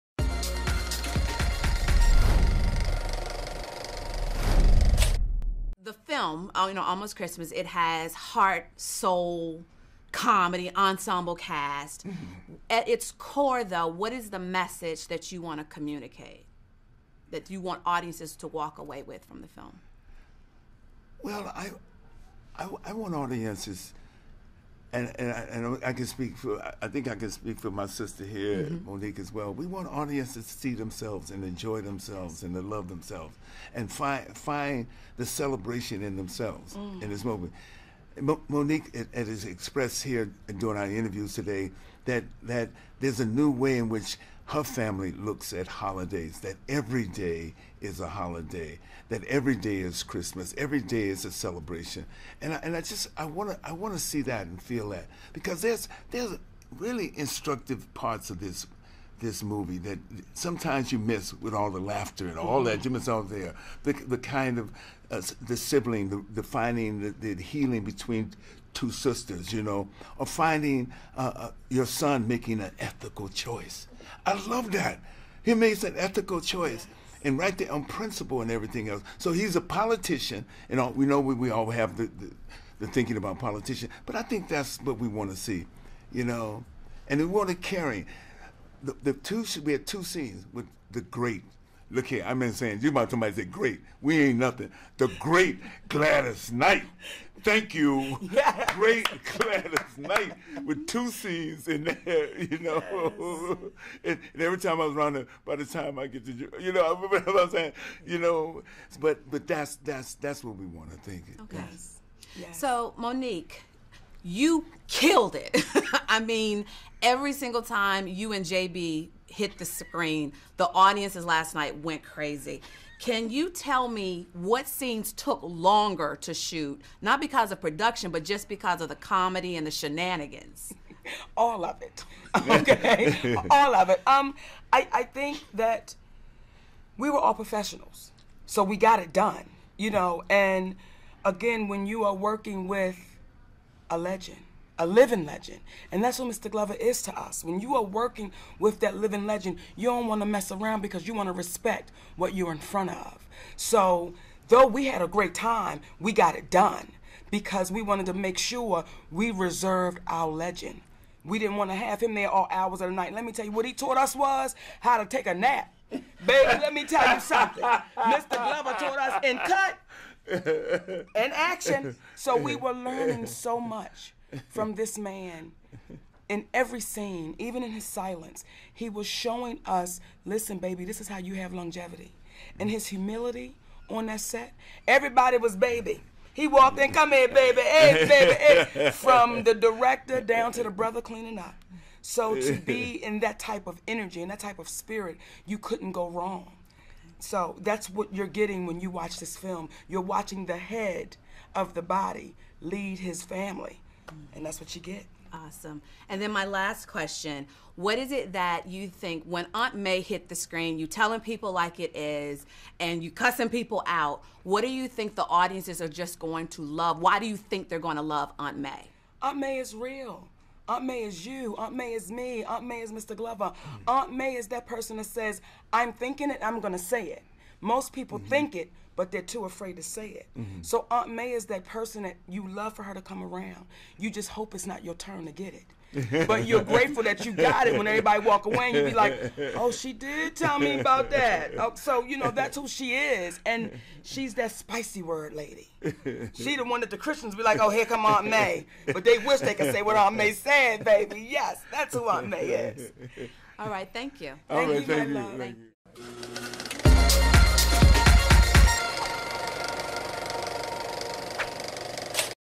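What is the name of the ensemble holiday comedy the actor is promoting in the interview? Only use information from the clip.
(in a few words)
Almost Christmas.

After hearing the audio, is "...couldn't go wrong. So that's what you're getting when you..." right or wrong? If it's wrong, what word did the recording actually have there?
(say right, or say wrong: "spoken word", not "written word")
right.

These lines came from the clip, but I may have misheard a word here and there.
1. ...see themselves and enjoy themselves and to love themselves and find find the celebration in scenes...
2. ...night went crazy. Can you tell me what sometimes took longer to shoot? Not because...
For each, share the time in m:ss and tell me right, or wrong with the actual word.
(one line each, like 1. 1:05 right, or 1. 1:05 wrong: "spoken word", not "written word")
1. 0:30 wrong: "themselves", not "scenes"
2. 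2:01 wrong: "scenes", not "sometimes".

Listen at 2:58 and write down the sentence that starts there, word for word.
He was showing us, listen, baby, this is how you have longevity.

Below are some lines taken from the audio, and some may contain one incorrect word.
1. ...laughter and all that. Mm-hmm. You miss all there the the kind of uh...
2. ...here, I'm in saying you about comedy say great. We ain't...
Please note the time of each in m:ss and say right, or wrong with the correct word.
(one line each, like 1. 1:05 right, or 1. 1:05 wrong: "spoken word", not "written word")
1. 1:01 right
2. 1:32 wrong: "somebody", not "comedy".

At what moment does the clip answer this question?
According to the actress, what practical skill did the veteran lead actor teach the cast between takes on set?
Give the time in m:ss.
2:44.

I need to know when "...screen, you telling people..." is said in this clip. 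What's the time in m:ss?
3:30.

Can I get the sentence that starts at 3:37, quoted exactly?
Why do you think they're going to love Aunt May?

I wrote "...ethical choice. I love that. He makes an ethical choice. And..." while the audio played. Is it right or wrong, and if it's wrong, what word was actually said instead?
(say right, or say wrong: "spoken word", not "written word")
right.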